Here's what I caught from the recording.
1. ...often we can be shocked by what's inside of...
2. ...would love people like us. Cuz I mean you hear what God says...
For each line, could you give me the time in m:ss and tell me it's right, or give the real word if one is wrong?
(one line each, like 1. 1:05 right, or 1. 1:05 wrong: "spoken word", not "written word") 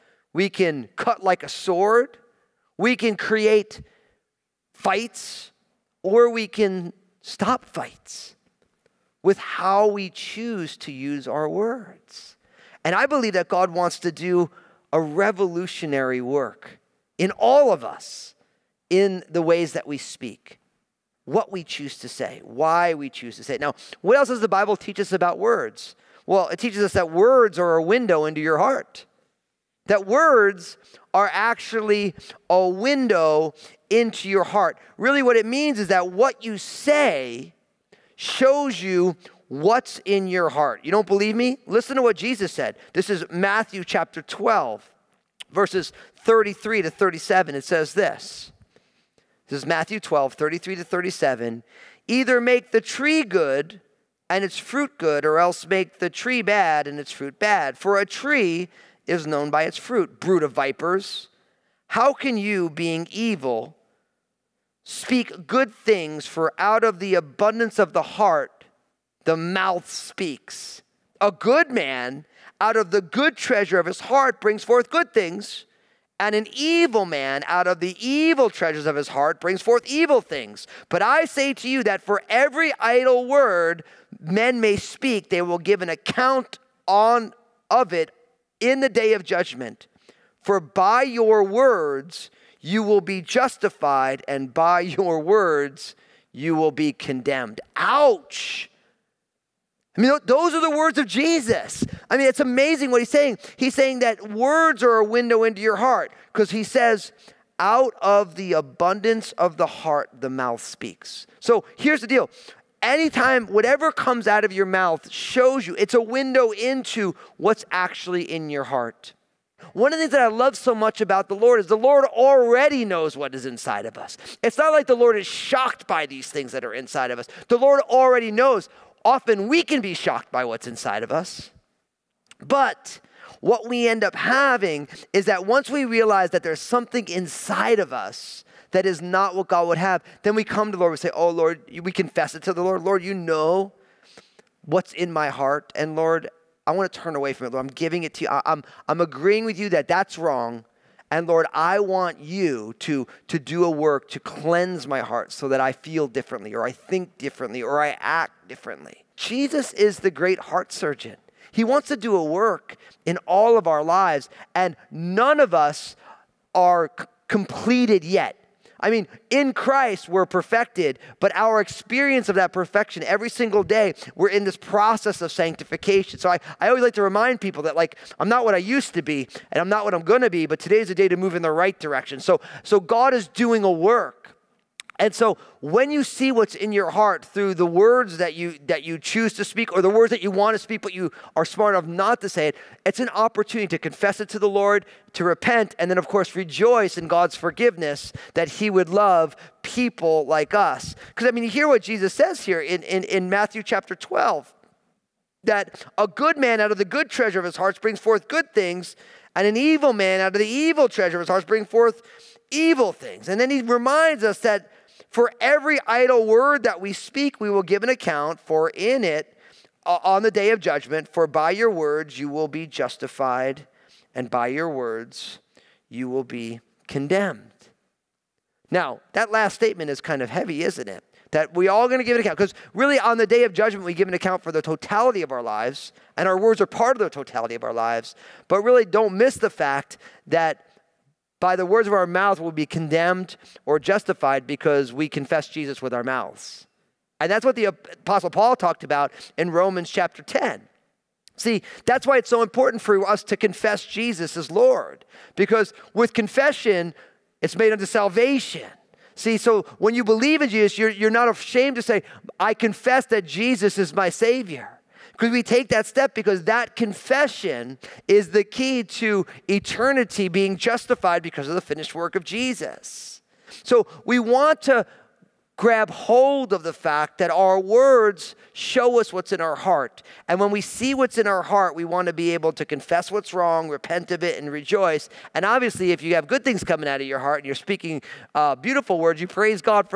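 1. 2:09 right
2. 3:18 wrong: "Jesus", not "God".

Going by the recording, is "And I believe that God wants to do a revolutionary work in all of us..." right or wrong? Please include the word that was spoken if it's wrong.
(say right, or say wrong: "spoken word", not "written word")
right.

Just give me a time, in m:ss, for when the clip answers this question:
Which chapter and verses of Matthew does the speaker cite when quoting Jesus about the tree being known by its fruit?
0:43.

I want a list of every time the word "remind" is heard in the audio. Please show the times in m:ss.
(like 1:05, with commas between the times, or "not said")
2:57, 3:33.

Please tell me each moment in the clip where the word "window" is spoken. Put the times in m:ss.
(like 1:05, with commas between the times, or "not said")
0:27, 0:32, 1:45, 1:56.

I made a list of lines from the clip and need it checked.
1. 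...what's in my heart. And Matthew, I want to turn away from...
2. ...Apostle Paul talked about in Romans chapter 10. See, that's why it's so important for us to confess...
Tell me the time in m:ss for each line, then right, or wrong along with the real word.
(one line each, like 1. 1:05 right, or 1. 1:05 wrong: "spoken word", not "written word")
1. 2:24 wrong: "Lord", not "Matthew"
2. 4:07 right.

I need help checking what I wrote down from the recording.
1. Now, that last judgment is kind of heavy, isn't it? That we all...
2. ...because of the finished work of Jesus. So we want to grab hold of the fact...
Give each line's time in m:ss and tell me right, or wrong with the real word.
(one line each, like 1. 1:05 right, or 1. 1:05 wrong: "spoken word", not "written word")
1. 3:48 wrong: "statement", not "judgment"
2. 4:31 right.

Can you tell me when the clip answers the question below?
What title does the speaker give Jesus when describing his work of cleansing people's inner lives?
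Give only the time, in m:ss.
2:40.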